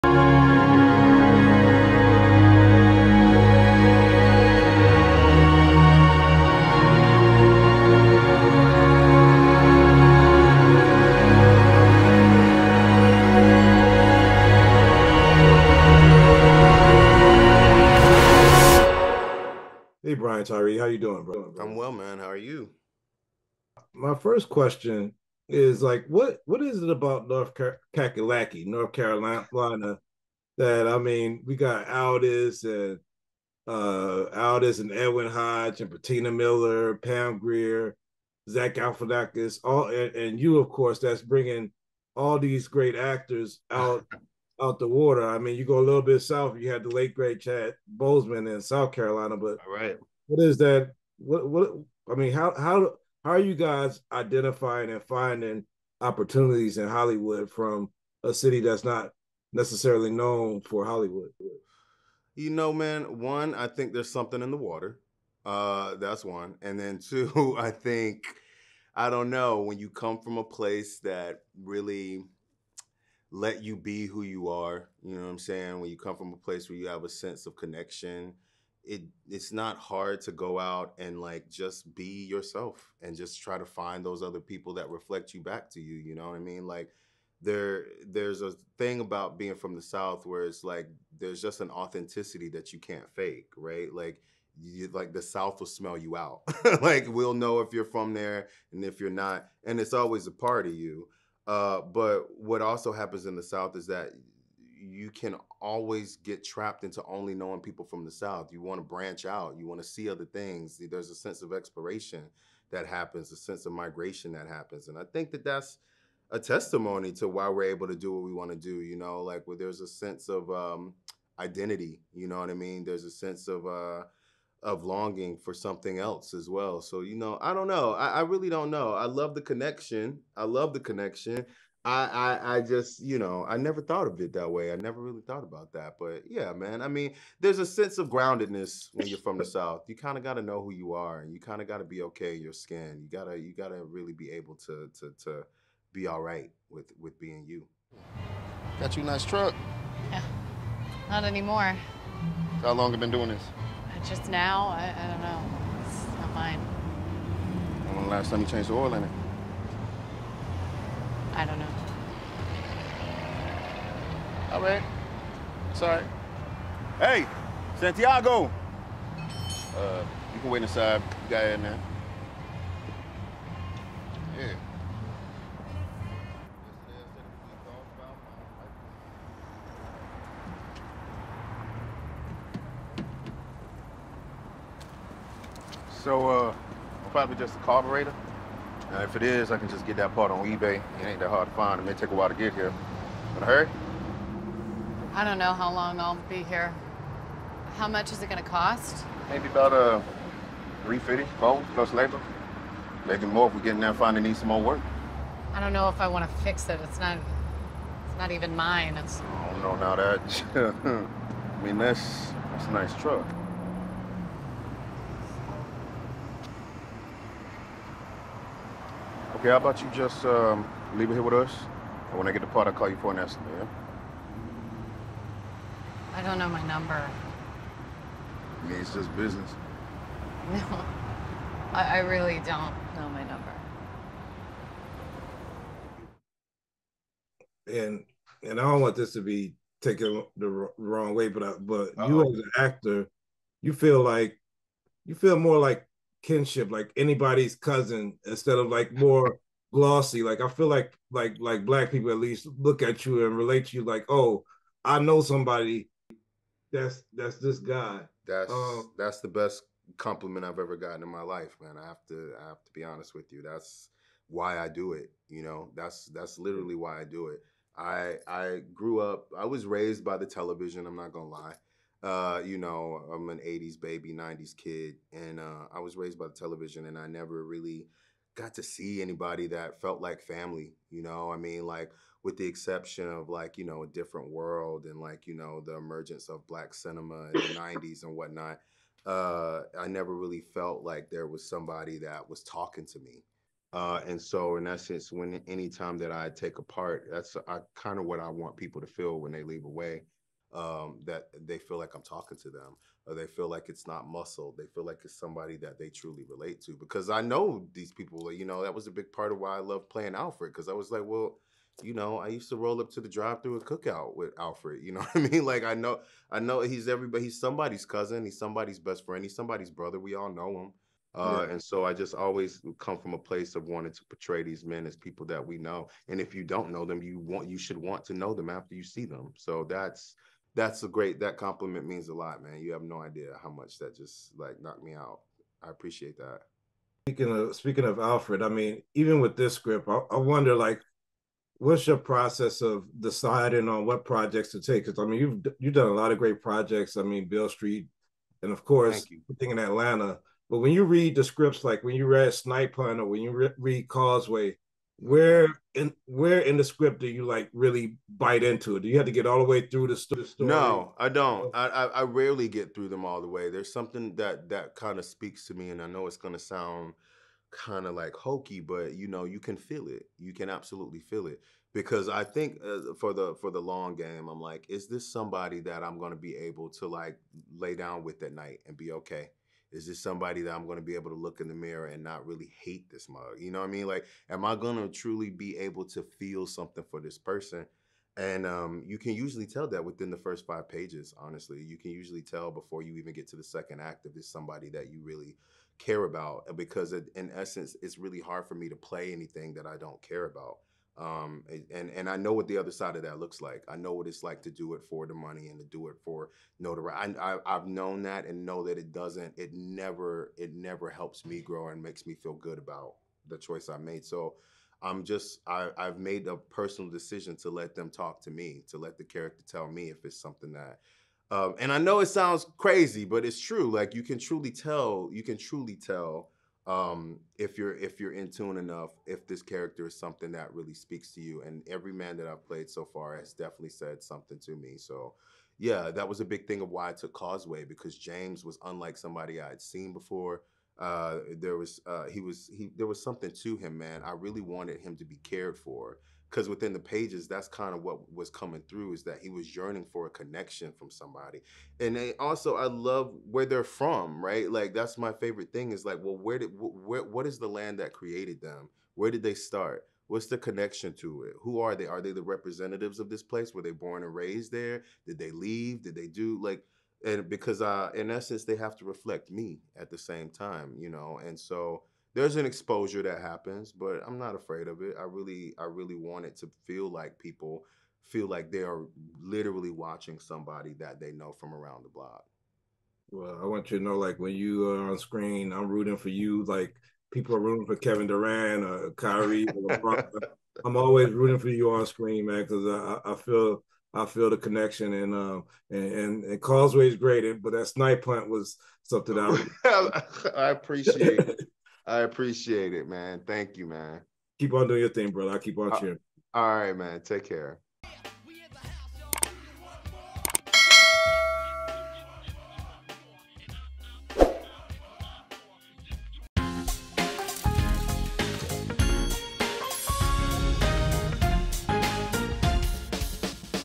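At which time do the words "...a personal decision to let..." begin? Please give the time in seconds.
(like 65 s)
416 s.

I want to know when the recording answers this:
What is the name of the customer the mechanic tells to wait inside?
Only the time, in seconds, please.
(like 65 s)
167 s.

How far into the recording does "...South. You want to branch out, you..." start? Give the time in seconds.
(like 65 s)
108 s.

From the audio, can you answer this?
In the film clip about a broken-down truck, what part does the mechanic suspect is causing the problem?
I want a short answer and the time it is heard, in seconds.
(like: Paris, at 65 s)
carburetor, at 187 s.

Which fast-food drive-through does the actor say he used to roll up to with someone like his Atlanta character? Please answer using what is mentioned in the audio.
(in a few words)
Cookout.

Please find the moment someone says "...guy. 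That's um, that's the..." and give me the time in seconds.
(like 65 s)
257 s.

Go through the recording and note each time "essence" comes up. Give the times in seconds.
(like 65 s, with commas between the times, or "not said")
294 s, 397 s, 468 s.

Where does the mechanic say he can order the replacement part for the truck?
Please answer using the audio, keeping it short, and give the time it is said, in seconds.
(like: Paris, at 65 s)
eBay, at 190 s.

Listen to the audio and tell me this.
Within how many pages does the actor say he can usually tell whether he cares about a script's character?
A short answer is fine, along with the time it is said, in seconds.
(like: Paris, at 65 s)
5, at 390 s.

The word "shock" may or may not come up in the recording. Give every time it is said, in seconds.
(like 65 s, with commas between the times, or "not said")
not said.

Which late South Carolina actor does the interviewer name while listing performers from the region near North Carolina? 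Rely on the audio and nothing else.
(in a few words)
Chad Boseman.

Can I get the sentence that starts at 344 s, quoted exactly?
Because I mean, you've you've done a lot of great projects.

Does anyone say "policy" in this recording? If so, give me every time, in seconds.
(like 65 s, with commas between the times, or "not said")
not said.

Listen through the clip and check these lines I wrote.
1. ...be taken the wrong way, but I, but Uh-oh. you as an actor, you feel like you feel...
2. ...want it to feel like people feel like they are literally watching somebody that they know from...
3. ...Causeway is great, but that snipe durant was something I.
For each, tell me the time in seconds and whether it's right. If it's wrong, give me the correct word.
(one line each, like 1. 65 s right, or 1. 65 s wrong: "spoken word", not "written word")
1. 239 s right
2. 475 s right
3. 496 s wrong: "plant", not "durant".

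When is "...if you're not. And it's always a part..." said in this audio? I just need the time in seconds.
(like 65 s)
98 s.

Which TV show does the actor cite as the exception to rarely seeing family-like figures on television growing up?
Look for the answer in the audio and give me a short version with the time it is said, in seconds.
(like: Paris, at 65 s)
A Different World, at 283 s.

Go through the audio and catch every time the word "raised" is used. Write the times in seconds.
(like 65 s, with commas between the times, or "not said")
269 s, 275 s, 464 s.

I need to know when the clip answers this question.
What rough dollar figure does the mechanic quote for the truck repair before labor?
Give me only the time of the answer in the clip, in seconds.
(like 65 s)
200 s.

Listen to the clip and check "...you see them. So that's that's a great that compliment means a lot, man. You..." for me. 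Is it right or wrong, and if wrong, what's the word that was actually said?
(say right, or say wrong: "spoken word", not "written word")
right.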